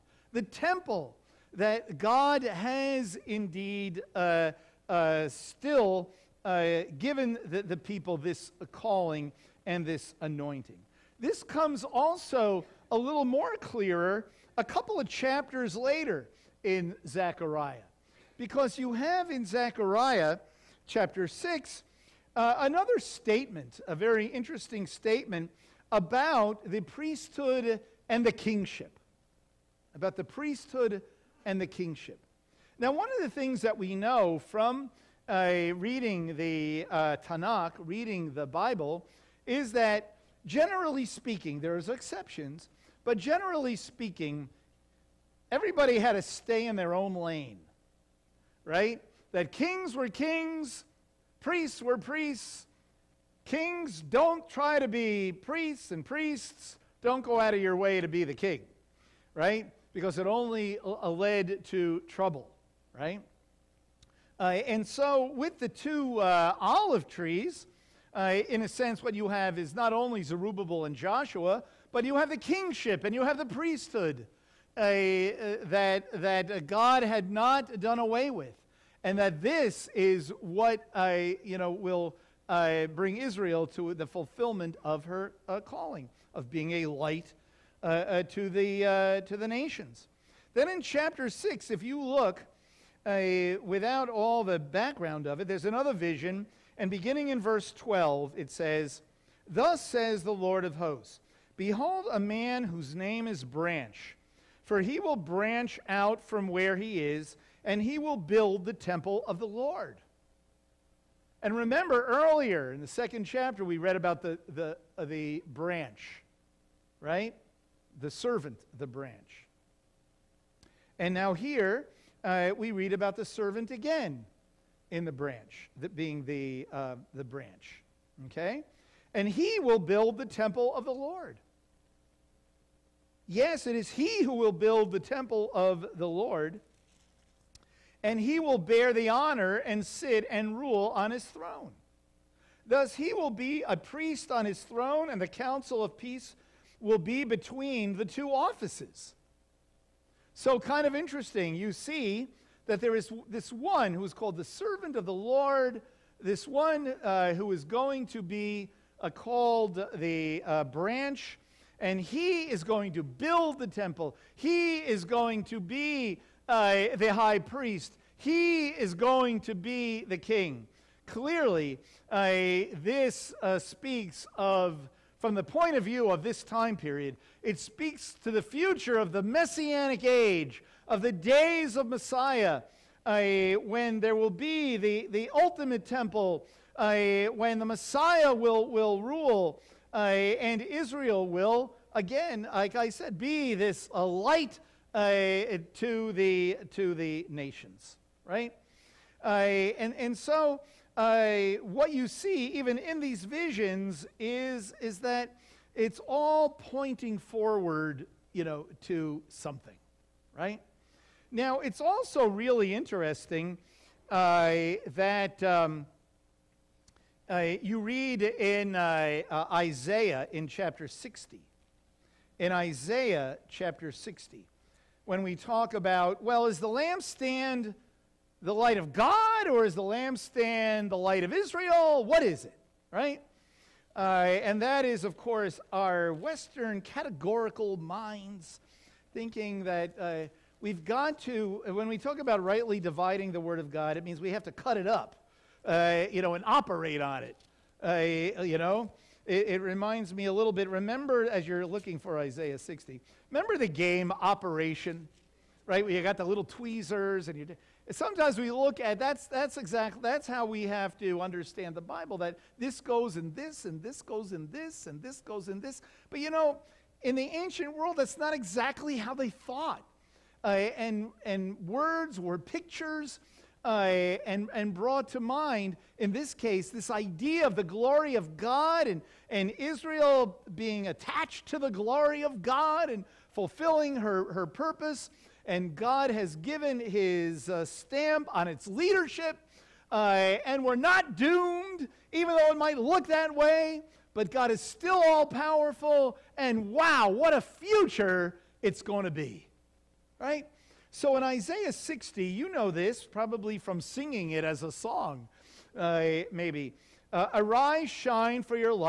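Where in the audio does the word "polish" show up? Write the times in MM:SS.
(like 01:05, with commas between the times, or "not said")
not said.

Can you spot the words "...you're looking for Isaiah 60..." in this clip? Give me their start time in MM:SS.
04:11.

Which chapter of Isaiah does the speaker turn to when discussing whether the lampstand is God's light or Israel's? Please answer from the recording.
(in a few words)
Chapter 60.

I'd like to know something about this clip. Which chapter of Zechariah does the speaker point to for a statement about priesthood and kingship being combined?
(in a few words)
Chapter 6.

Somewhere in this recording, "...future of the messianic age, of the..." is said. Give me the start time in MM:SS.
02:58.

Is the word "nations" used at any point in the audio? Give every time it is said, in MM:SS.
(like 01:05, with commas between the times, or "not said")
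01:29, 03:17.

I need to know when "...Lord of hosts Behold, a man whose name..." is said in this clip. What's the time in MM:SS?
01:40.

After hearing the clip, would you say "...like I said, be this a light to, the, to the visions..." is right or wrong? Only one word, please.
wrong.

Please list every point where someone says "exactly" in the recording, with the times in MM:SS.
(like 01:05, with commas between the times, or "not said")
04:19, 04:28.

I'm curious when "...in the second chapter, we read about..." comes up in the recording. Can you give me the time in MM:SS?
01:52.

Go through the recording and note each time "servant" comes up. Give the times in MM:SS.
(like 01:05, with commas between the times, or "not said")
01:58, 02:03, 02:34.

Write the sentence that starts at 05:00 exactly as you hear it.
So in Isaiah 60, you know this probably from singing it as a song, uh, maybe.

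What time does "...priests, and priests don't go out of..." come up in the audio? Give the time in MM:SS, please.
00:55.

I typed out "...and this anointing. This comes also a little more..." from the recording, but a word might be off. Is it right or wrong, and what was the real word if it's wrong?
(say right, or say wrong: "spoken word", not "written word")
right.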